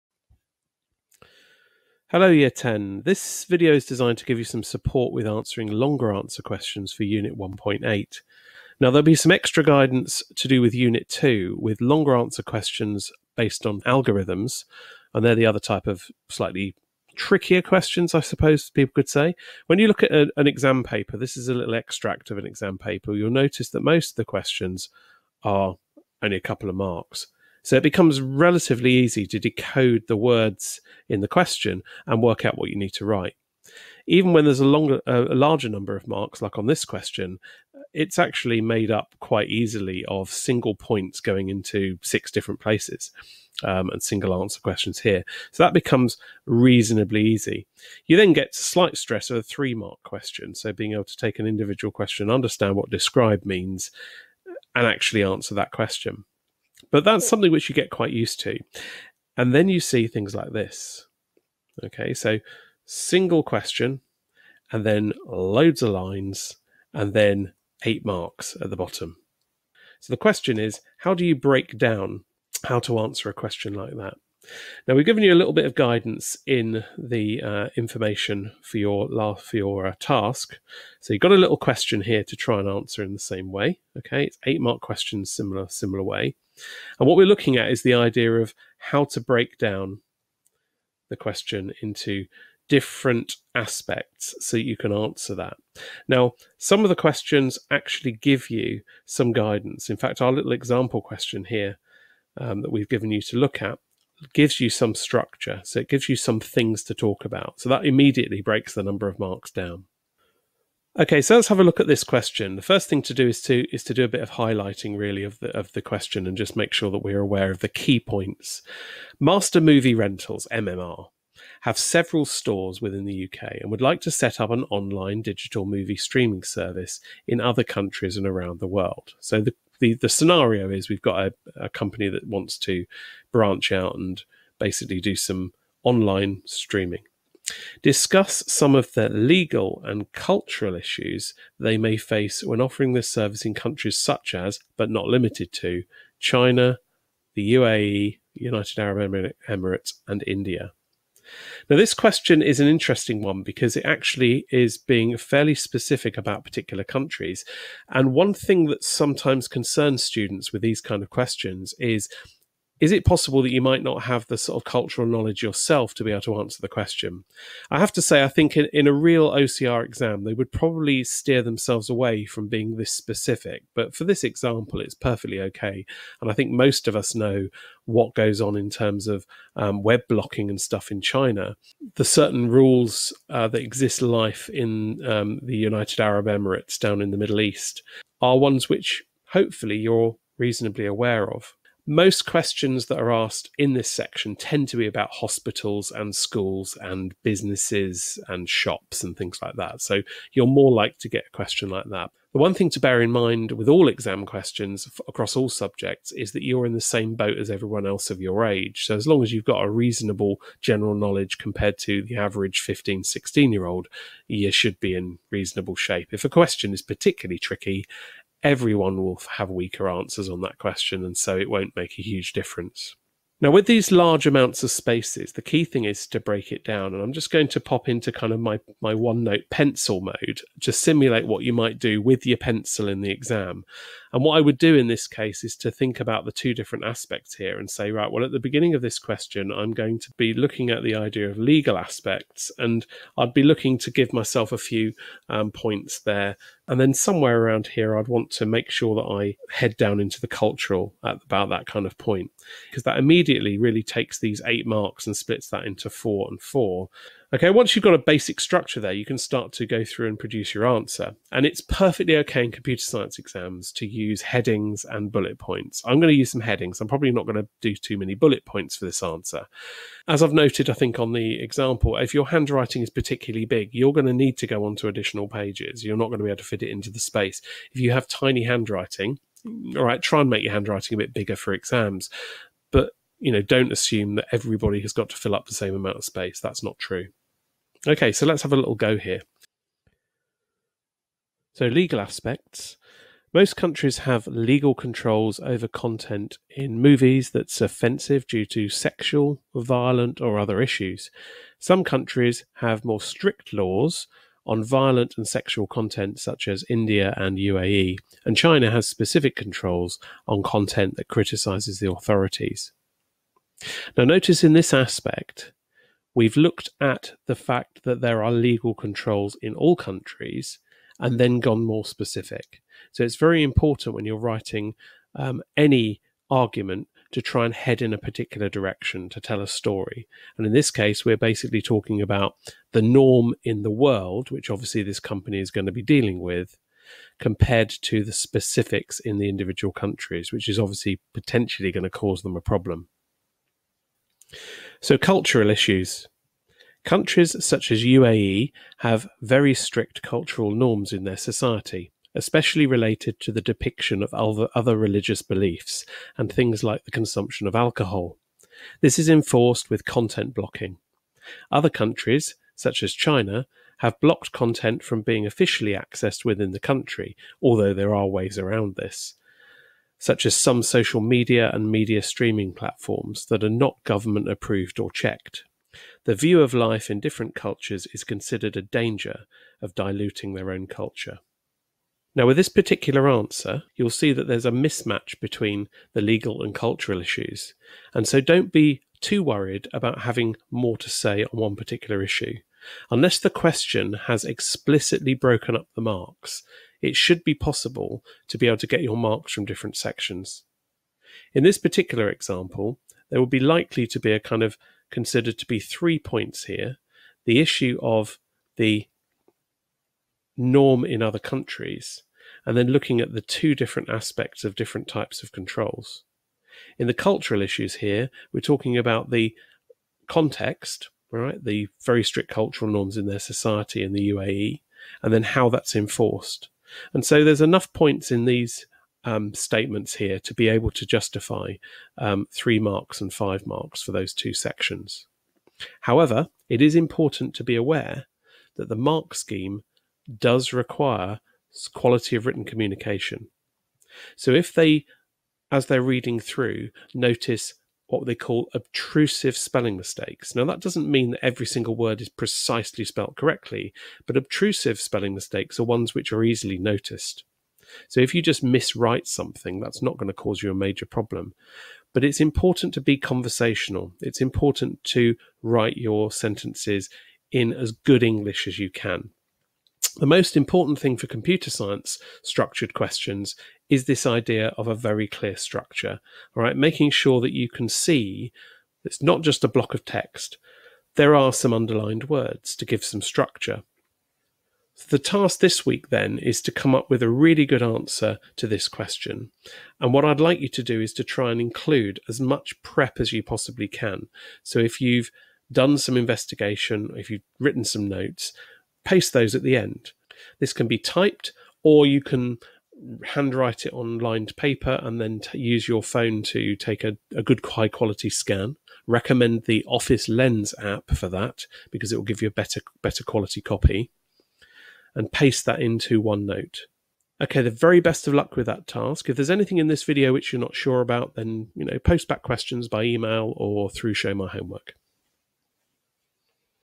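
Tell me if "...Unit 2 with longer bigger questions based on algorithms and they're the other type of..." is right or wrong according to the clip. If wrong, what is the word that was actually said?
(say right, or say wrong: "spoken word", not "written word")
wrong: "answer", not "bigger".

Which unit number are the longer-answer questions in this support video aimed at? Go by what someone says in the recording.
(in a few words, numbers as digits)
1.8.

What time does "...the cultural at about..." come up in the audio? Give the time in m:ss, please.
4:10.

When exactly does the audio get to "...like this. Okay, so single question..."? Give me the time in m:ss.
1:00.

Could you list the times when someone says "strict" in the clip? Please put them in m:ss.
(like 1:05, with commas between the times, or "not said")
5:03, 5:49, 7:02.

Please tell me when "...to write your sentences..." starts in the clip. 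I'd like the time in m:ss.
7:44.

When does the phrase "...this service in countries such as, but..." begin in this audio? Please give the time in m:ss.
2:22.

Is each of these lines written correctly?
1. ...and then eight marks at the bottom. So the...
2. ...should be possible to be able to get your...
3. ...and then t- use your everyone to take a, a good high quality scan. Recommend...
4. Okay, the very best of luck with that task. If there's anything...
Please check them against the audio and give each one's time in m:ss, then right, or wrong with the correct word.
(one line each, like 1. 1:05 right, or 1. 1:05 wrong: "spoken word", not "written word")
1. 1:06 right
2. 6:36 right
3. 8:24 wrong: "phone", not "everyone"
4. 8:37 right.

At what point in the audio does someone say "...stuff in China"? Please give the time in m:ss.
3:00.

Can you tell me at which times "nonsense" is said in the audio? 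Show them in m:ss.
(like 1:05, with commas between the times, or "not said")
not said.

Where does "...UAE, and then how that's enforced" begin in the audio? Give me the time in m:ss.
7:04.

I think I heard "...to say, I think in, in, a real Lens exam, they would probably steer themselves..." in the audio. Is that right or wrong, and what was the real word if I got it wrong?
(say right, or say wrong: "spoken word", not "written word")
wrong: "OCR", not "Lens".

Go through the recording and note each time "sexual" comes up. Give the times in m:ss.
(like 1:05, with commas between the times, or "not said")
4:58, 5:05.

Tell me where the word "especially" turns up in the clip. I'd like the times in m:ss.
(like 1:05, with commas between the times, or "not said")
5:52.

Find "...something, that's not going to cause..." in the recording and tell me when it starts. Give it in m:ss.
7:39.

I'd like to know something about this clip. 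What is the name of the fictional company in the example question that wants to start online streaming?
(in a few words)
Master Movie Rentals.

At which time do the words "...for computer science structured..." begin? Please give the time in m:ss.
7:50.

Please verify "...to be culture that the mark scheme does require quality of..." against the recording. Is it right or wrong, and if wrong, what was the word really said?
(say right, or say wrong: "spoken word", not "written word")
wrong: "aware", not "culture".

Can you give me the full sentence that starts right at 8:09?
And what I'd like you to do is to try and include as much prep as you possibly can.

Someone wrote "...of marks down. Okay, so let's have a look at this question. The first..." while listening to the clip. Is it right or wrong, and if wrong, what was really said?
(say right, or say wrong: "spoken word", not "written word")
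right.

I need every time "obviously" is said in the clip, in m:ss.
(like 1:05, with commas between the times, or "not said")
5:34, 5:40.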